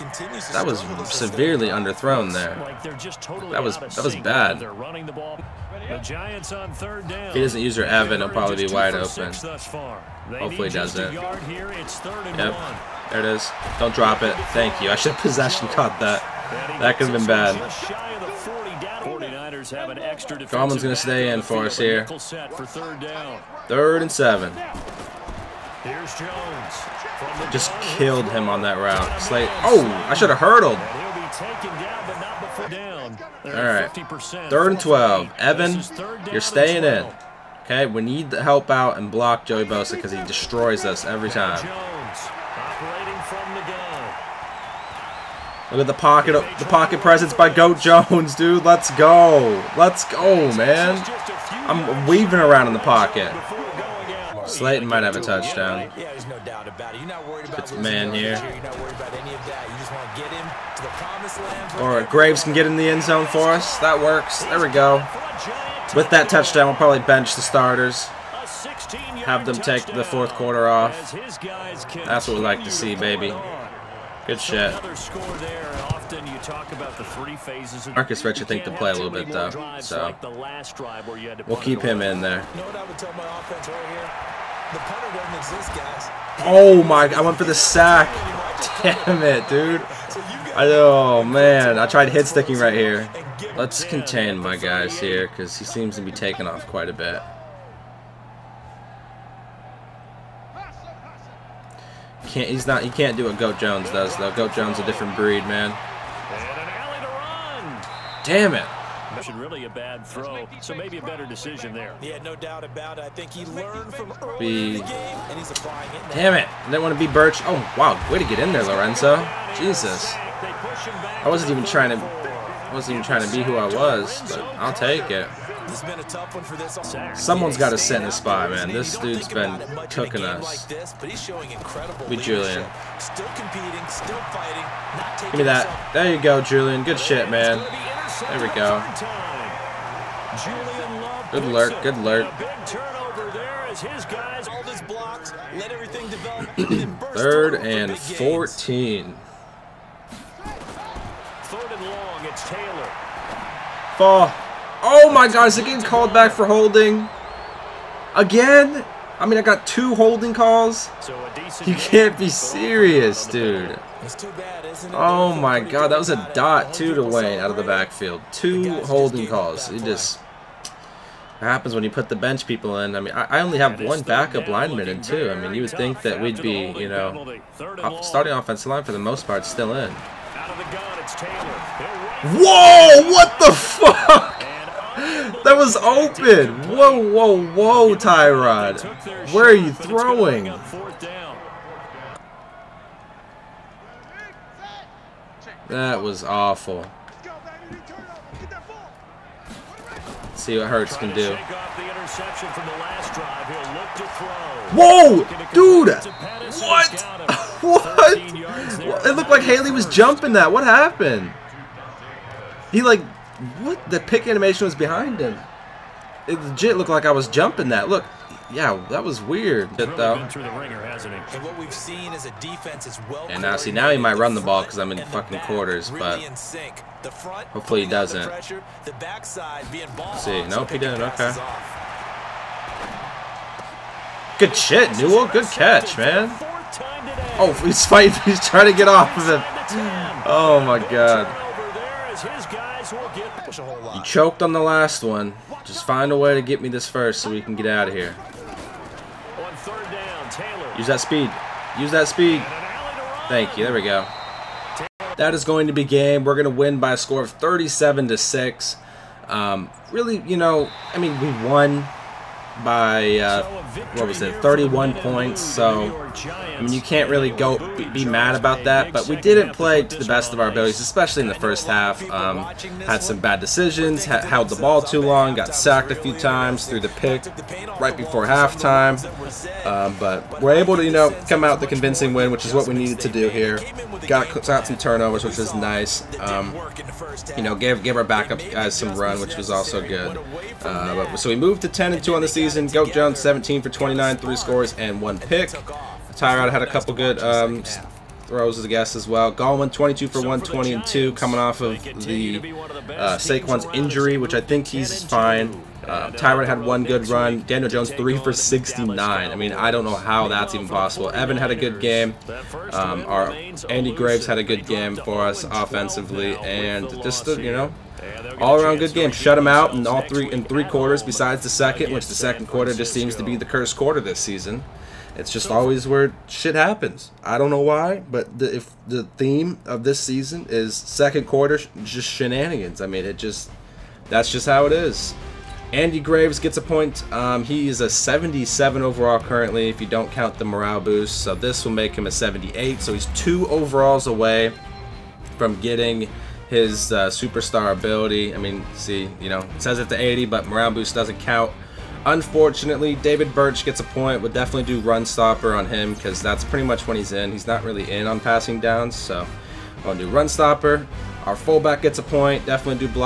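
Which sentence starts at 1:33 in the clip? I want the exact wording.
Let's contain my guys here because he seems to be taking off quite a bit.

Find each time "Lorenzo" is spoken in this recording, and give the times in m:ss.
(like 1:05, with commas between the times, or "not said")
1:58.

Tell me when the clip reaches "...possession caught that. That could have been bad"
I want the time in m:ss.
0:15.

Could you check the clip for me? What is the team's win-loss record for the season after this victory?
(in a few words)
10 and 2.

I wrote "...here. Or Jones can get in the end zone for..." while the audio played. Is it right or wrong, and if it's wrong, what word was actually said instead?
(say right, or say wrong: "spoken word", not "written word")
wrong: "Graves", not "Jones".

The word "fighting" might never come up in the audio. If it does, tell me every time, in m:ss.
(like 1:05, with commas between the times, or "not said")
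2:14, 3:57.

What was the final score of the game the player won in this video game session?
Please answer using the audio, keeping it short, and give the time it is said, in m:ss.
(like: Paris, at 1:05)
37 to 6, at 4:17.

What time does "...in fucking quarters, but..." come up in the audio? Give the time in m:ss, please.
3:44.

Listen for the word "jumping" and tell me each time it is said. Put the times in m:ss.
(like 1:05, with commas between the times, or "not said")
3:29, 3:37.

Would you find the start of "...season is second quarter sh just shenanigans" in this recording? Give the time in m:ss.
5:29.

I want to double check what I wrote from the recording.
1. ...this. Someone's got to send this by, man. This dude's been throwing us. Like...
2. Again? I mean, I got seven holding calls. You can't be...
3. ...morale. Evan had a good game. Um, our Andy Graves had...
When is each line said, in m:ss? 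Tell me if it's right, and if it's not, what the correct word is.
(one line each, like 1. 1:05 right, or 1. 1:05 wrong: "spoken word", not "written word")
1. 2:06 wrong: "cooking", not "throwing"
2. 2:38 wrong: "two", not "seven"
3. 5:10 wrong: "possible", not "morale".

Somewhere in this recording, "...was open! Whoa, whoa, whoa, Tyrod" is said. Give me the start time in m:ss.
3:05.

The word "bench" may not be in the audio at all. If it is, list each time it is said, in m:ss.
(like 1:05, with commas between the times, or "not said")
1:06, 2:52.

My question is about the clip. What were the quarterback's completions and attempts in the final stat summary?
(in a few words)
17 for 29.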